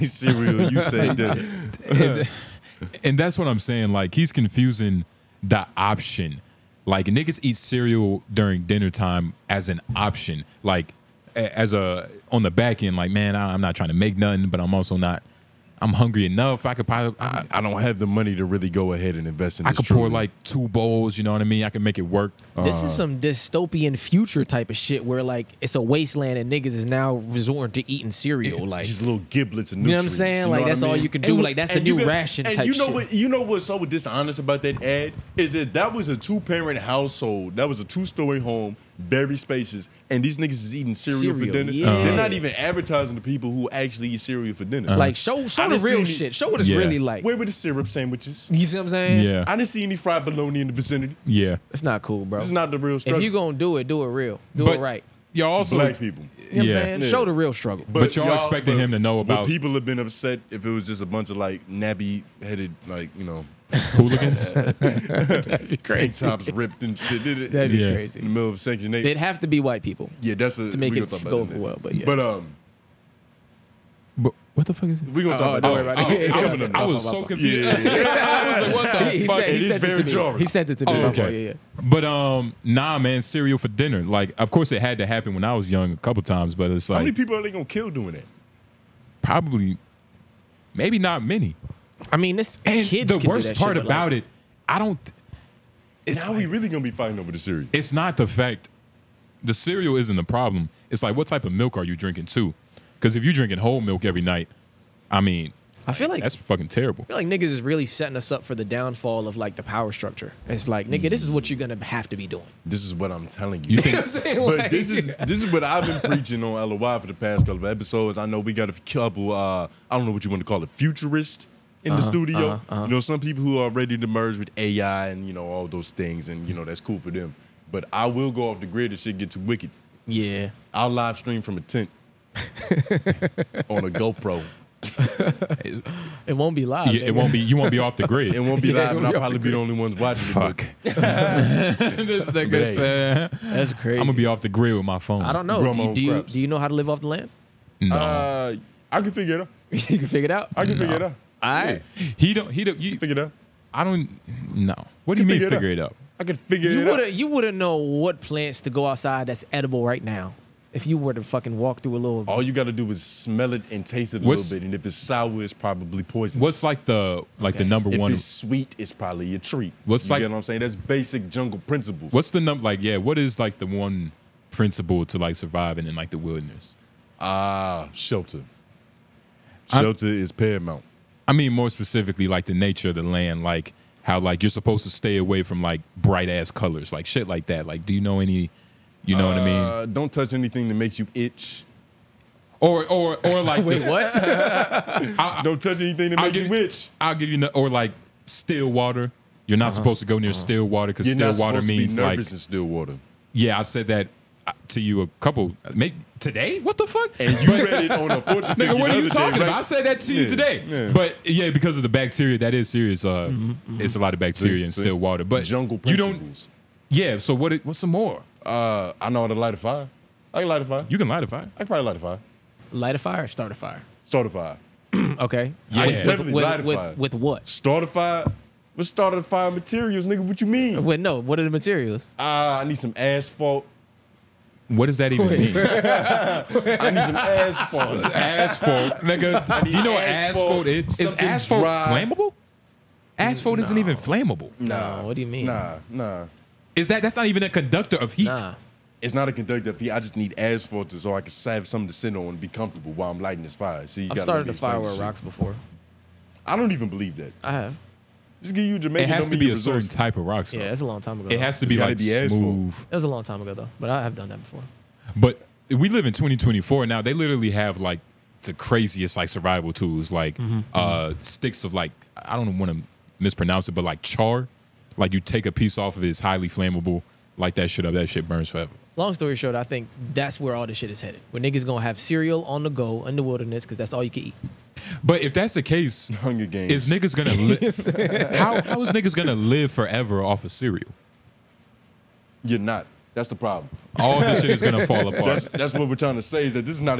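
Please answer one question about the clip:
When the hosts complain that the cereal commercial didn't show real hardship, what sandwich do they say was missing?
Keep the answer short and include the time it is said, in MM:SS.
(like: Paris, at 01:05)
syrup sandwiches, at 00:47.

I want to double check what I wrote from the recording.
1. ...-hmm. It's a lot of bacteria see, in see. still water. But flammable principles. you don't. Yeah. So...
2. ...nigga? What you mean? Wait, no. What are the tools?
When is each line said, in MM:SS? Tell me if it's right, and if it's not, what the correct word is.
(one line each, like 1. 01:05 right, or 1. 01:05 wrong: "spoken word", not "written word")
1. 03:33 wrong: "jungle", not "flammable"
2. 03:50 wrong: "materials", not "tools".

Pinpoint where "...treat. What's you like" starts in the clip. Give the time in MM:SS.
02:49.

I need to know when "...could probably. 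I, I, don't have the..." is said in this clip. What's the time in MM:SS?
00:16.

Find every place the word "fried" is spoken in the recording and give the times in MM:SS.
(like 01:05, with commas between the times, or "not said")
00:49.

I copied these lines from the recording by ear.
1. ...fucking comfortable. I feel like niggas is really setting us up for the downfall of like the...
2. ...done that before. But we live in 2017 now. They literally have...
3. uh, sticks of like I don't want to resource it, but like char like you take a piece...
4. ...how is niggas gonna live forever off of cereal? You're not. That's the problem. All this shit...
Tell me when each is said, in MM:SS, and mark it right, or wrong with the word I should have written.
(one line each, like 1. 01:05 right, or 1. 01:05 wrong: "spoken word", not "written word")
1. 01:46 wrong: "terrible", not "comfortable"
2. 04:24 wrong: "2024", not "2017"
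3. 04:30 wrong: "mispronounce", not "resource"
4. 04:48 right.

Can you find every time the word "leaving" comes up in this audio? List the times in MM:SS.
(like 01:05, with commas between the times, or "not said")
not said.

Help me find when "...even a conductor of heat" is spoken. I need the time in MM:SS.
04:07.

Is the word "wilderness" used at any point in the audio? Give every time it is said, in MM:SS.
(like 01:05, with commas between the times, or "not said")
02:56, 04:43.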